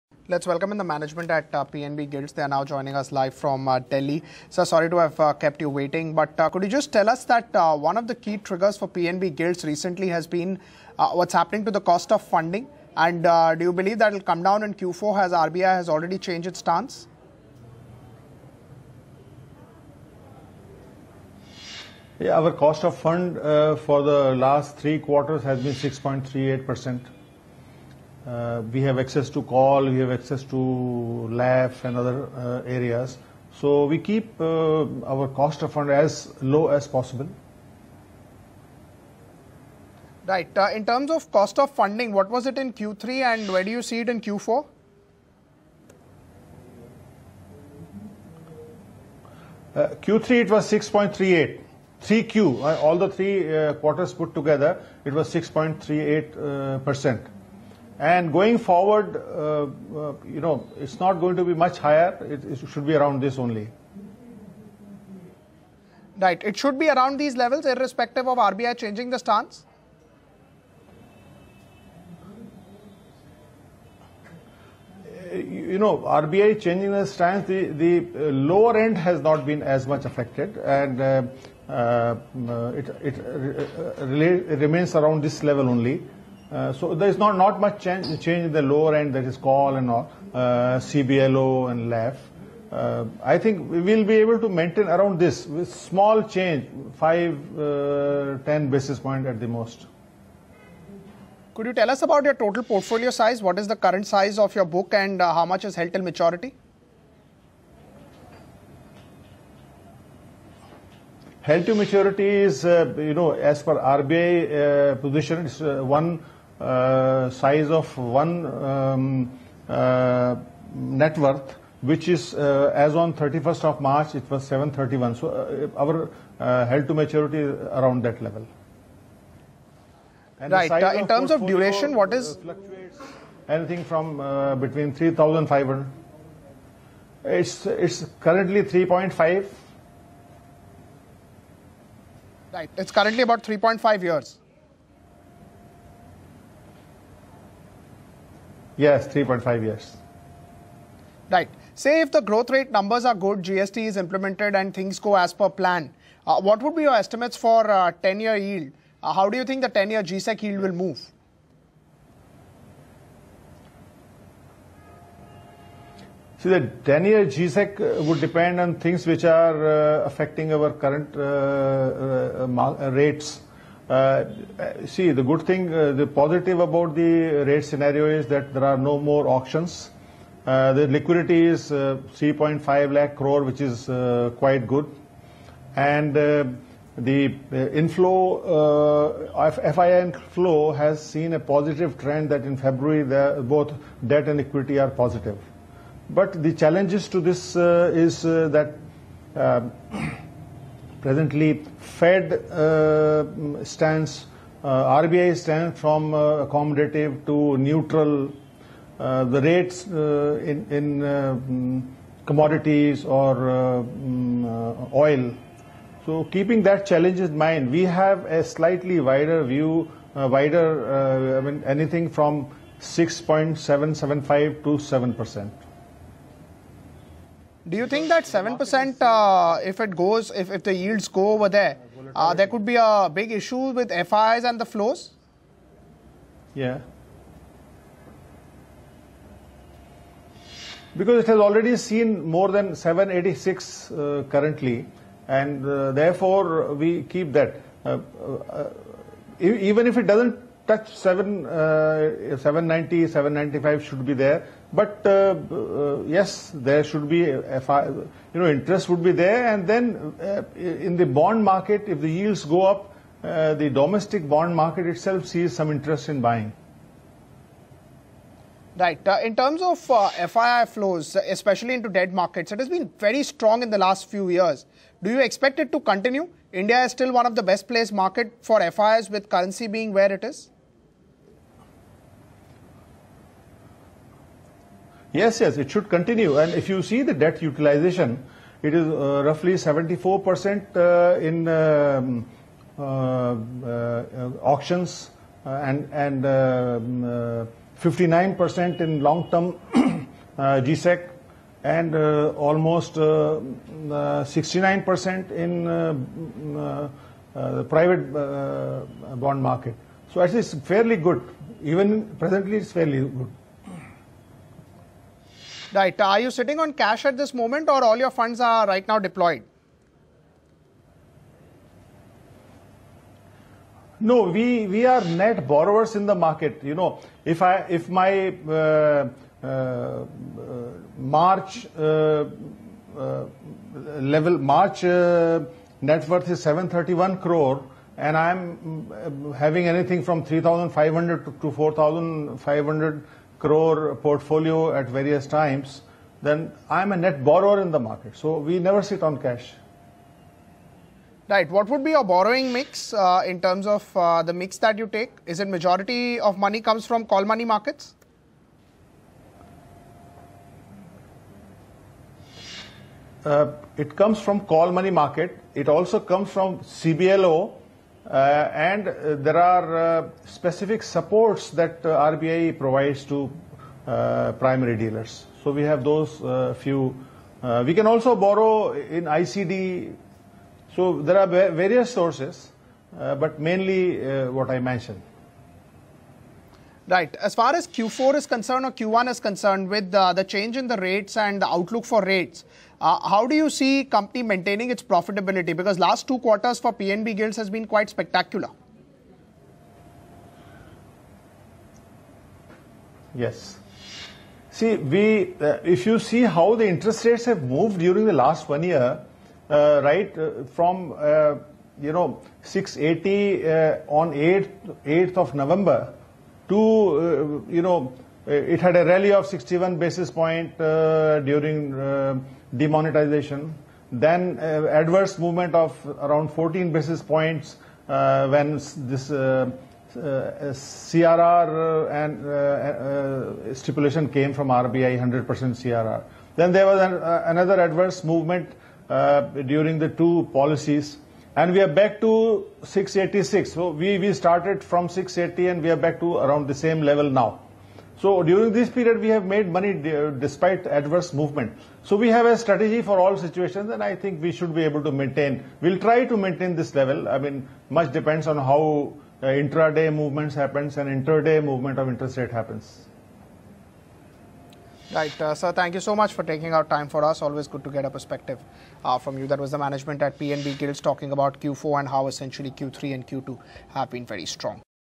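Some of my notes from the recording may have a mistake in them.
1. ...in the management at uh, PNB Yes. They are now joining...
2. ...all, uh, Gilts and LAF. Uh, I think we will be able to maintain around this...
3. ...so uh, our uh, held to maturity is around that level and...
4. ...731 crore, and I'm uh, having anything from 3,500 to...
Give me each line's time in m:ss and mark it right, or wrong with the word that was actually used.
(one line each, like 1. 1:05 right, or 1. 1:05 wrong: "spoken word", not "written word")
1. 0:00 wrong: "Gilts", not "Yes"
2. 1:29 wrong: "CBLO", not "Gilts"
3. 2:05 right
4. 5:36 right.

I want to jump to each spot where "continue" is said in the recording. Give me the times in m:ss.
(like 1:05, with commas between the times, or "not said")
4:35, 4:45.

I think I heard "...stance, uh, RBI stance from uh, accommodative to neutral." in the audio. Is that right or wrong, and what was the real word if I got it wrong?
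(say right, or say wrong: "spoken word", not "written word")
right.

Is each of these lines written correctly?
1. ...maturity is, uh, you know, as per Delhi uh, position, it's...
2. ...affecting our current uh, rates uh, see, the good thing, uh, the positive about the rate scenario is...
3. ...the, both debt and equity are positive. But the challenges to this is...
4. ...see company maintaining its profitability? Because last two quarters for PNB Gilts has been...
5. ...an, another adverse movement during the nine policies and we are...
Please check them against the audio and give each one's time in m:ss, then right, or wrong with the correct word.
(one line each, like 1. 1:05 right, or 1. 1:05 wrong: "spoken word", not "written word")
1. 1:51 wrong: "RBI", not "Delhi"
2. 2:50 right
3. 3:13 right
4. 6:33 right
5. 7:16 wrong: "two", not "nine".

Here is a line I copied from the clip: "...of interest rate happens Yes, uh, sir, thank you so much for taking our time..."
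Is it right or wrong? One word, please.
wrong.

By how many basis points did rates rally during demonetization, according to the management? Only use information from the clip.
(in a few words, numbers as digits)
61.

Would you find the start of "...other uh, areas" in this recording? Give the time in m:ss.
0:31.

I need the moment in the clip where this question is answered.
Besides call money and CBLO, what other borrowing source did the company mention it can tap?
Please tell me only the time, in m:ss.
6:19.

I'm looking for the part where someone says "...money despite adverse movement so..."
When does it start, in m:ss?
7:29.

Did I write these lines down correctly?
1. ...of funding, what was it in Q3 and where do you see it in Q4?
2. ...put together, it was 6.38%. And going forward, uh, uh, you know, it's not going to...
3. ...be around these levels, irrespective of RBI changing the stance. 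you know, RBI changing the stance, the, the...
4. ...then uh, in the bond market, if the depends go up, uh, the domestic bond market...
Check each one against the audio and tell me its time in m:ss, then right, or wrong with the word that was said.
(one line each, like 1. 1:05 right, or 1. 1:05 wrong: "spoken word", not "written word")
1. 0:41 right
2. 0:54 right
3. 1:06 right
4. 4:19 wrong: "yields", not "depends".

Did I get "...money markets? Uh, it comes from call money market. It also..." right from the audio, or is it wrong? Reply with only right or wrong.
right.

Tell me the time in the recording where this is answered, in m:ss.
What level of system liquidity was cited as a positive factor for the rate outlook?
3:01.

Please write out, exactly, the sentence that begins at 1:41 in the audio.
Could you tell us about your total portfolio size?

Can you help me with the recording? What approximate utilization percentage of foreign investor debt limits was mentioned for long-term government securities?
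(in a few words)
59%.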